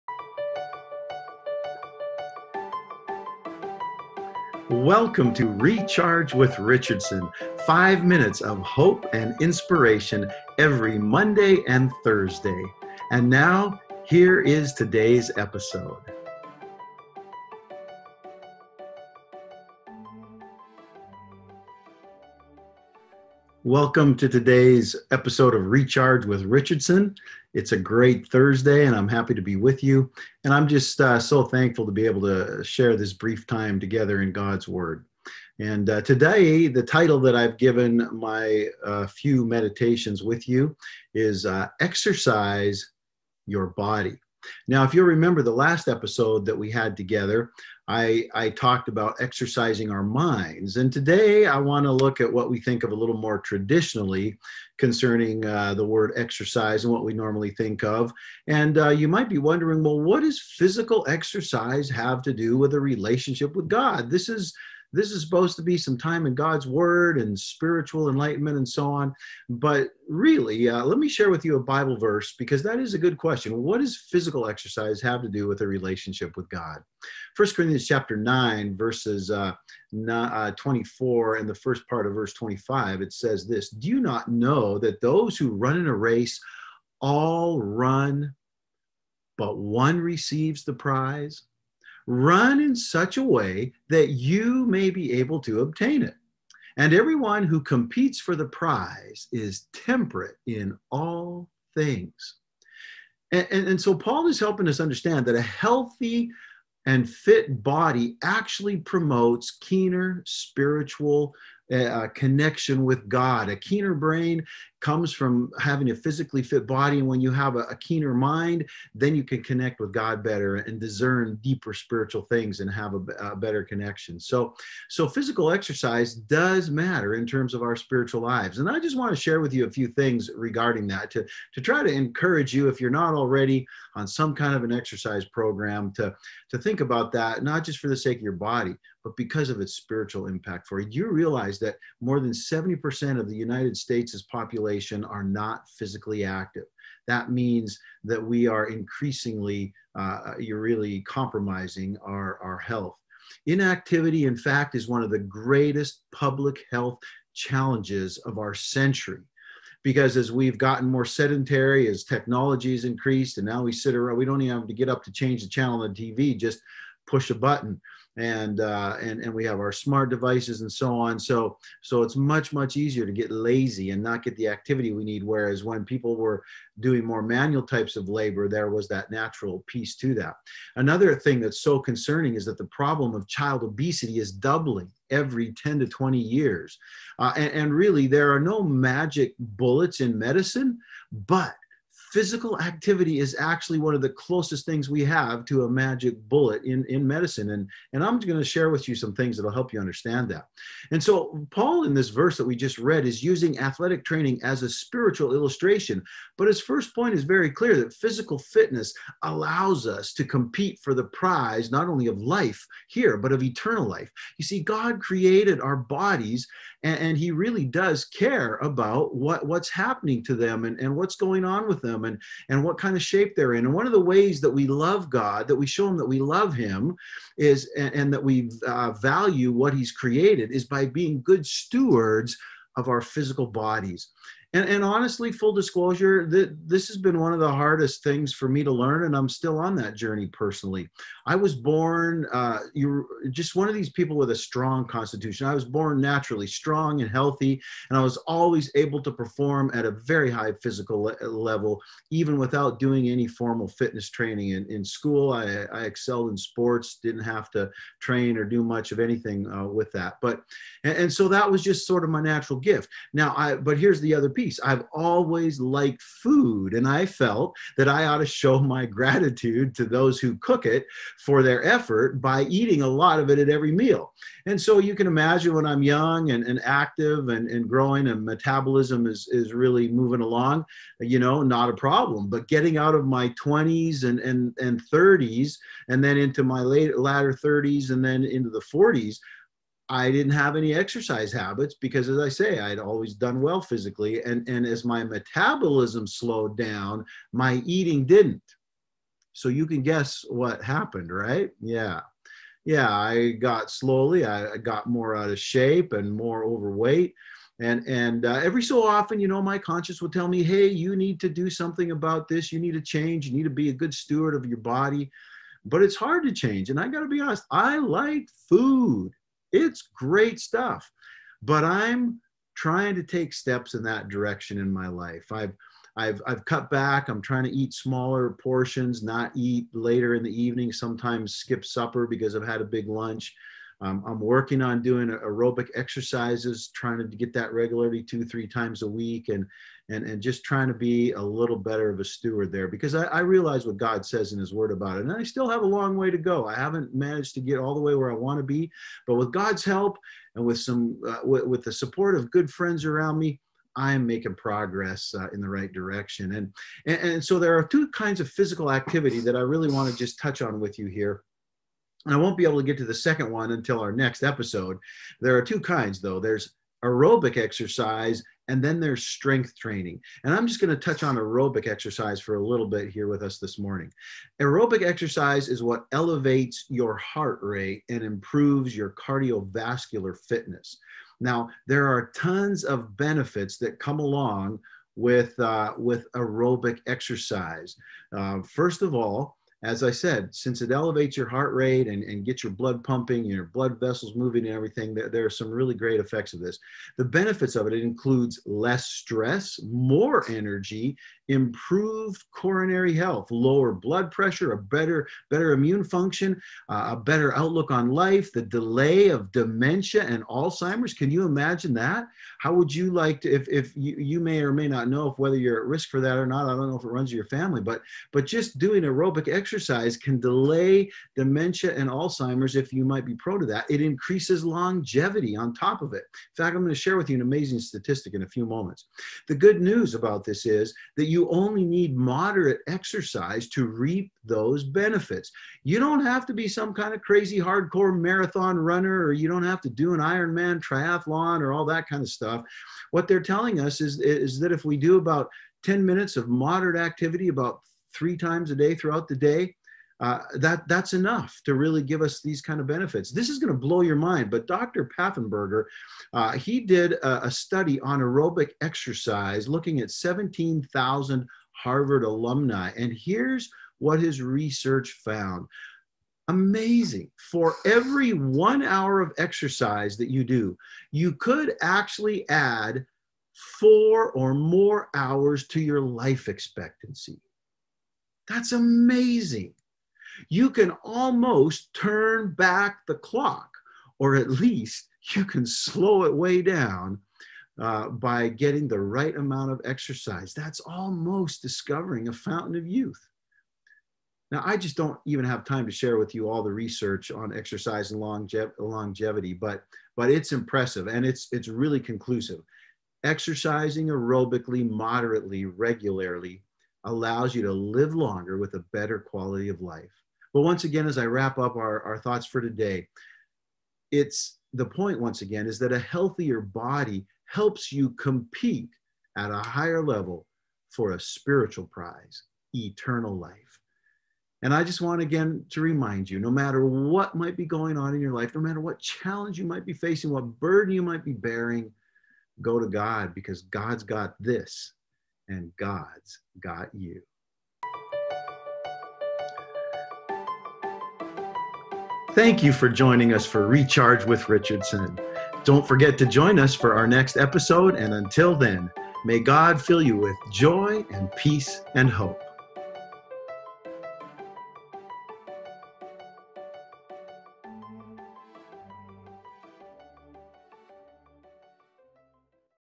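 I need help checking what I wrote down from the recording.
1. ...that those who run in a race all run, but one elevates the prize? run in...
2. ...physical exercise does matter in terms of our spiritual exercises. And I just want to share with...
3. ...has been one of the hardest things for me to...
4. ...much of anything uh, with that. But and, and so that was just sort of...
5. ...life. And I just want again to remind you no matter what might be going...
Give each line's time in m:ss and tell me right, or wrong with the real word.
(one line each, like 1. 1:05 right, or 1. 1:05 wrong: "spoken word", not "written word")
1. 1:24 wrong: "receives", not "elevates"
2. 2:05 wrong: "lives", not "exercises"
3. 3:56 right
4. 4:18 right
5. 8:43 right.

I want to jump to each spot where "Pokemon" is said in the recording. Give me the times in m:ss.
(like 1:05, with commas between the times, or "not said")
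not said.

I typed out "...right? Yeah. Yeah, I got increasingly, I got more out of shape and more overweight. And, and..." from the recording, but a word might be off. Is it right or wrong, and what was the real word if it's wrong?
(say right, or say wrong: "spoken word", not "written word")
wrong: "slowly", not "increasingly".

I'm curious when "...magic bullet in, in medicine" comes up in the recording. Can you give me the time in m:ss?
3:15.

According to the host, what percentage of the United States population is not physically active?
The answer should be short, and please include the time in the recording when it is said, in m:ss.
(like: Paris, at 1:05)
70%, at 2:22.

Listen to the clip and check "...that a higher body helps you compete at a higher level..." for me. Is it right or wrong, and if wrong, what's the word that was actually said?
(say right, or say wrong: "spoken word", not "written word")
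wrong: "healthier", not "higher".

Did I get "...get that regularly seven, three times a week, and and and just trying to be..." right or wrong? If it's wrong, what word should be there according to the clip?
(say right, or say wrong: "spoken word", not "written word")
wrong: "two", not "seven".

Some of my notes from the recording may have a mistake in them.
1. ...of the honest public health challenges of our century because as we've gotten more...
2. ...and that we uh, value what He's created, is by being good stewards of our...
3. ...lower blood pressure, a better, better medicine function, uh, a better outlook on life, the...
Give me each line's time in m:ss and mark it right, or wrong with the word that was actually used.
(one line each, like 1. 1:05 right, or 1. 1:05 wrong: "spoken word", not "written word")
1. 2:35 wrong: "greatest", not "honest"
2. 3:47 right
3. 6:43 wrong: "immune", not "medicine".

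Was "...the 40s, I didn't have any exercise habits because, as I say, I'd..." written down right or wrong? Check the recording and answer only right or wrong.
right.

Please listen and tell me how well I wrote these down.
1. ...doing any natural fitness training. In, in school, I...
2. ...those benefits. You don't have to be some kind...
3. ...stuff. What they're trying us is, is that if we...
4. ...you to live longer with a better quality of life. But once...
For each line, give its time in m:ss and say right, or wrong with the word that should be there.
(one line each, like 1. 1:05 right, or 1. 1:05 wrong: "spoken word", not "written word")
1. 4:12 wrong: "formal", not "natural"
2. 7:14 right
3. 7:22 wrong: "telling", not "trying"
4. 8:27 right.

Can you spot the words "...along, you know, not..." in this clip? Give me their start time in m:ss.
4:40.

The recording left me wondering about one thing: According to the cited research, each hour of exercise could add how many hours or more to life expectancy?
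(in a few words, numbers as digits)
4.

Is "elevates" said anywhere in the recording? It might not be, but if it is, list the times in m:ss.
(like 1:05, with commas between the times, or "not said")
6:15, 6:30.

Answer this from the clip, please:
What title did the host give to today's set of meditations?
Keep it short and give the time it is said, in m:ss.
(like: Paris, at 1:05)
Exercise Your Body, at 0:41.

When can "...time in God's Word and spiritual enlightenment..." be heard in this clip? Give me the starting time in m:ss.
1:05.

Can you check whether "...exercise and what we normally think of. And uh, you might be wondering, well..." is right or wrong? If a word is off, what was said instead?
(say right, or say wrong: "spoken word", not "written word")
right.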